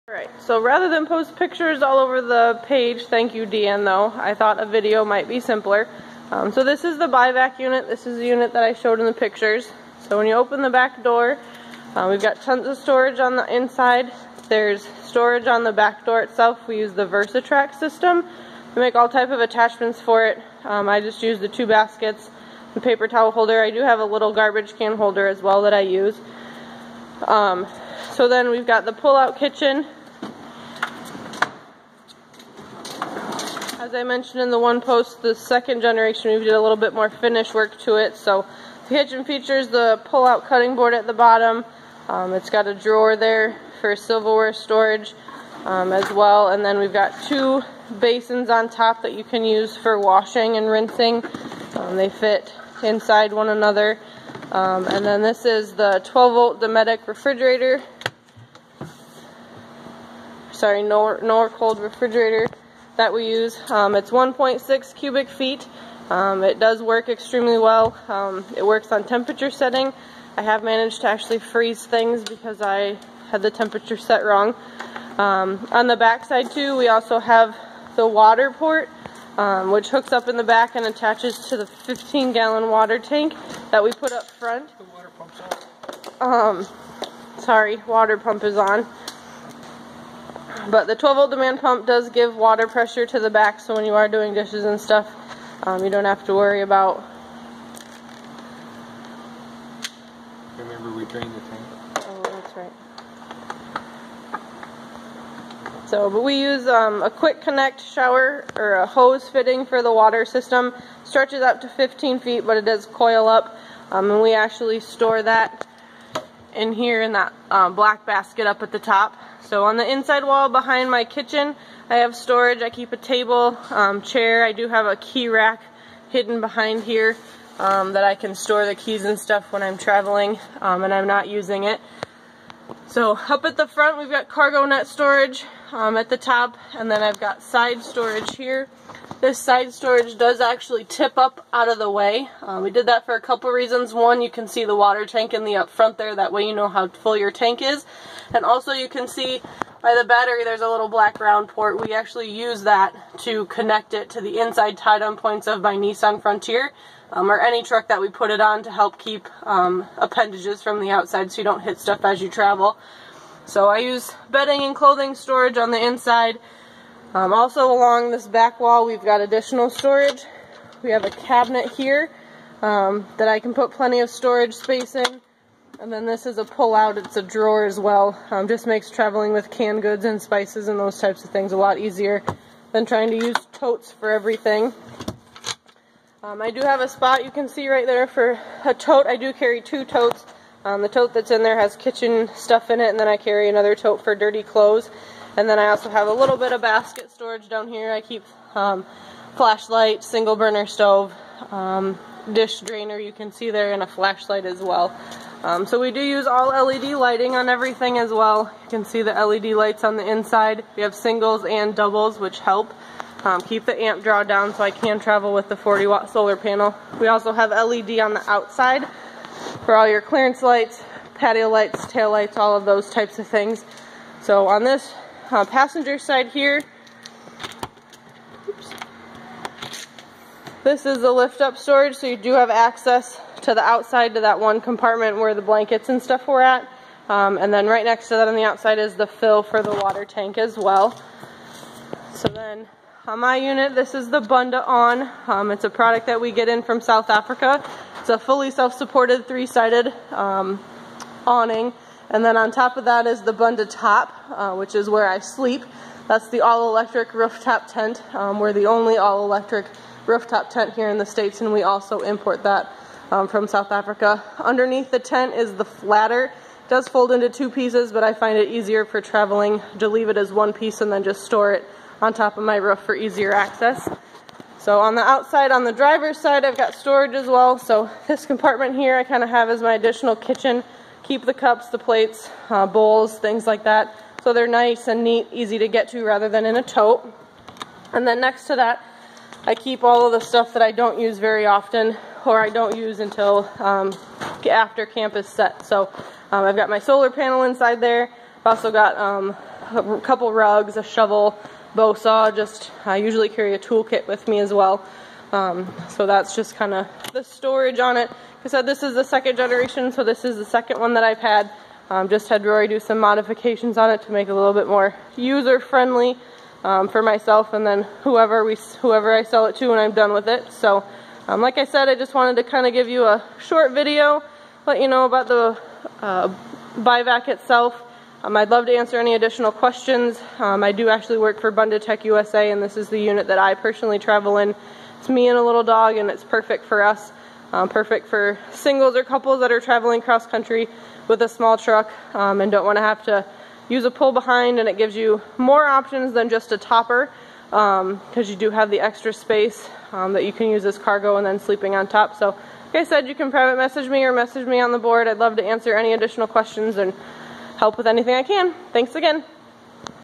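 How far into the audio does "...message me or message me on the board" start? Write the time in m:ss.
5:53.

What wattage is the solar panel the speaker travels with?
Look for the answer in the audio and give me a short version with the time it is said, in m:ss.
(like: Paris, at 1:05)
40 watt, at 3:35.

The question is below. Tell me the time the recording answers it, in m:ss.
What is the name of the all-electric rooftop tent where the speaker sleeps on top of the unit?
4:13.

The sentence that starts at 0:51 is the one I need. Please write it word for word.
Um, they fit inside one another.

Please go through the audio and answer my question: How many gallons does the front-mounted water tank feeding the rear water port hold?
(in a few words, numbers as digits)
15 gallon.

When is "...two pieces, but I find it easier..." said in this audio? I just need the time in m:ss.
4:27.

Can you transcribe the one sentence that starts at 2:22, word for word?
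Uh, we did that for a couple reasons.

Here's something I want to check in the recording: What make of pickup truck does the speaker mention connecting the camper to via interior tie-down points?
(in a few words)
Nissan Frontier.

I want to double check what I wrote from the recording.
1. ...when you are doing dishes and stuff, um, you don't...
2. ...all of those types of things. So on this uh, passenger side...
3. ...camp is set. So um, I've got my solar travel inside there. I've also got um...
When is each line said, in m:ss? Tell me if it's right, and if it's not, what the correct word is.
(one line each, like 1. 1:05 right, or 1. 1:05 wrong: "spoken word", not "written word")
1. 1:33 right
2. 3:42 right
3. 4:54 wrong: "panel", not "travel".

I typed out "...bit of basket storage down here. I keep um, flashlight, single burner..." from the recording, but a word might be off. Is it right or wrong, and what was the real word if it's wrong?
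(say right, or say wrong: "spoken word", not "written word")
right.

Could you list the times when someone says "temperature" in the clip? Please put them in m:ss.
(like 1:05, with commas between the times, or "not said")
1:09, 1:13.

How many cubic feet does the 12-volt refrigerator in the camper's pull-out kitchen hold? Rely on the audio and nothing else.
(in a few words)
1.6 cubic feet.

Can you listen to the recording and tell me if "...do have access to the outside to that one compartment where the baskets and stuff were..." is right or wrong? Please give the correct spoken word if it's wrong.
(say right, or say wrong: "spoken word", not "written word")
wrong: "blankets", not "baskets".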